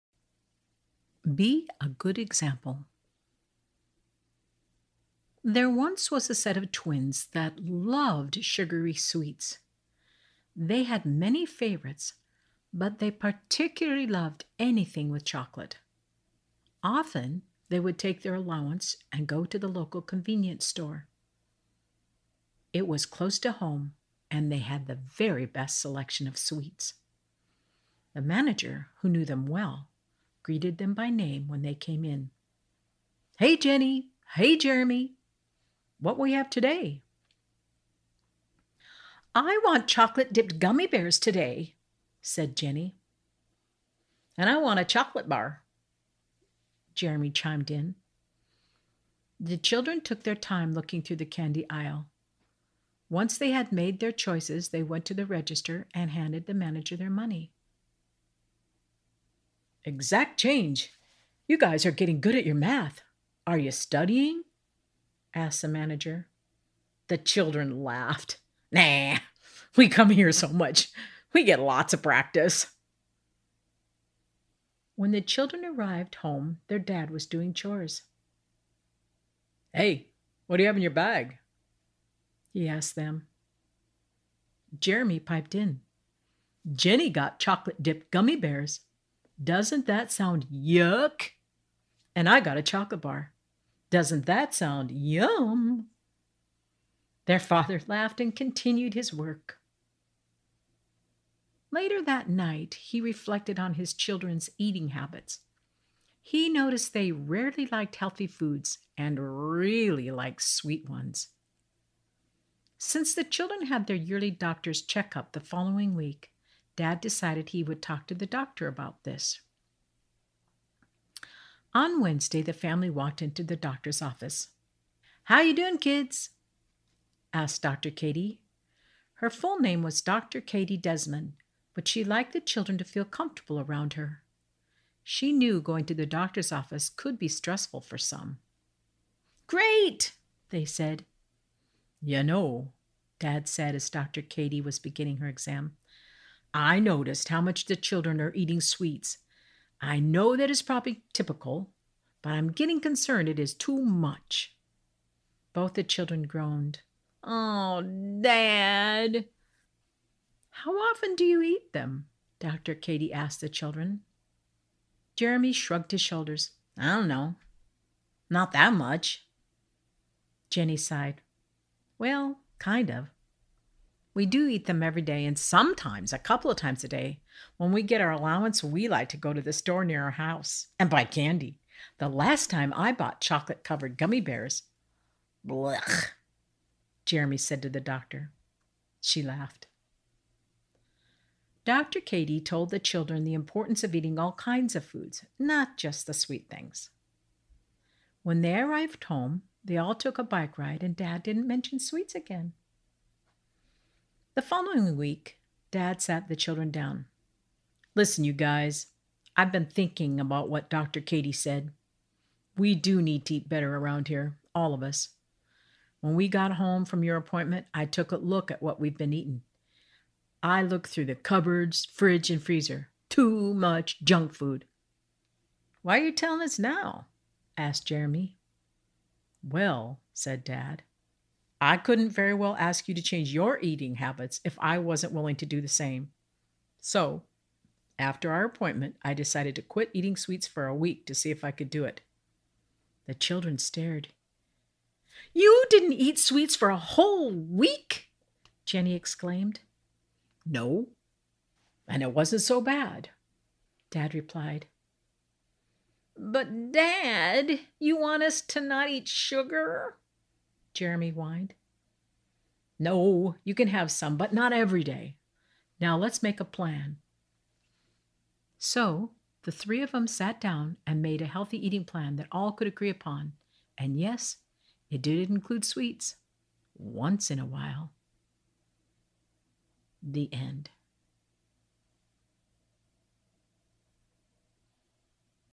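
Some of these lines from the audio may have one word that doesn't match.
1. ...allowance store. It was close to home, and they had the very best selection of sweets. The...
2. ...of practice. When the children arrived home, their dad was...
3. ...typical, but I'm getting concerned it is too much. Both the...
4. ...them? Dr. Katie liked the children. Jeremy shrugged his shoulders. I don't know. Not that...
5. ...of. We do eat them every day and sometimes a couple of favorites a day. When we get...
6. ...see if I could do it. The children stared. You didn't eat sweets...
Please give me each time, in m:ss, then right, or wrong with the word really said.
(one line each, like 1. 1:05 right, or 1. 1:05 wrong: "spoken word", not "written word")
1. 0:20 wrong: "convenience", not "allowance"
2. 1:11 right
3. 2:31 right
4. 2:41 wrong: "asked", not "liked"
5. 2:52 wrong: "times", not "favorites"
6. 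4:01 right.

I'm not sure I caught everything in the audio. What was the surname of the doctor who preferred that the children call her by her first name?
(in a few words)
Desmond.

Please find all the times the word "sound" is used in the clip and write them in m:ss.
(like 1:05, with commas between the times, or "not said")
1:30, 1:34.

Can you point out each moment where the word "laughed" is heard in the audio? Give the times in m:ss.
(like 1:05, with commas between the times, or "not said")
1:07, 1:37, 3:09.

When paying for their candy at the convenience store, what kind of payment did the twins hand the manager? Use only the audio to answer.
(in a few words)
Exact change.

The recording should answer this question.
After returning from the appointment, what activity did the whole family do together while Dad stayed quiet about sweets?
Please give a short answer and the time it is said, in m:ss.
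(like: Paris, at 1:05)
Bike ride, at 3:20.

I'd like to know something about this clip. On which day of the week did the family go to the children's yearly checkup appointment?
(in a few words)
Wednesday.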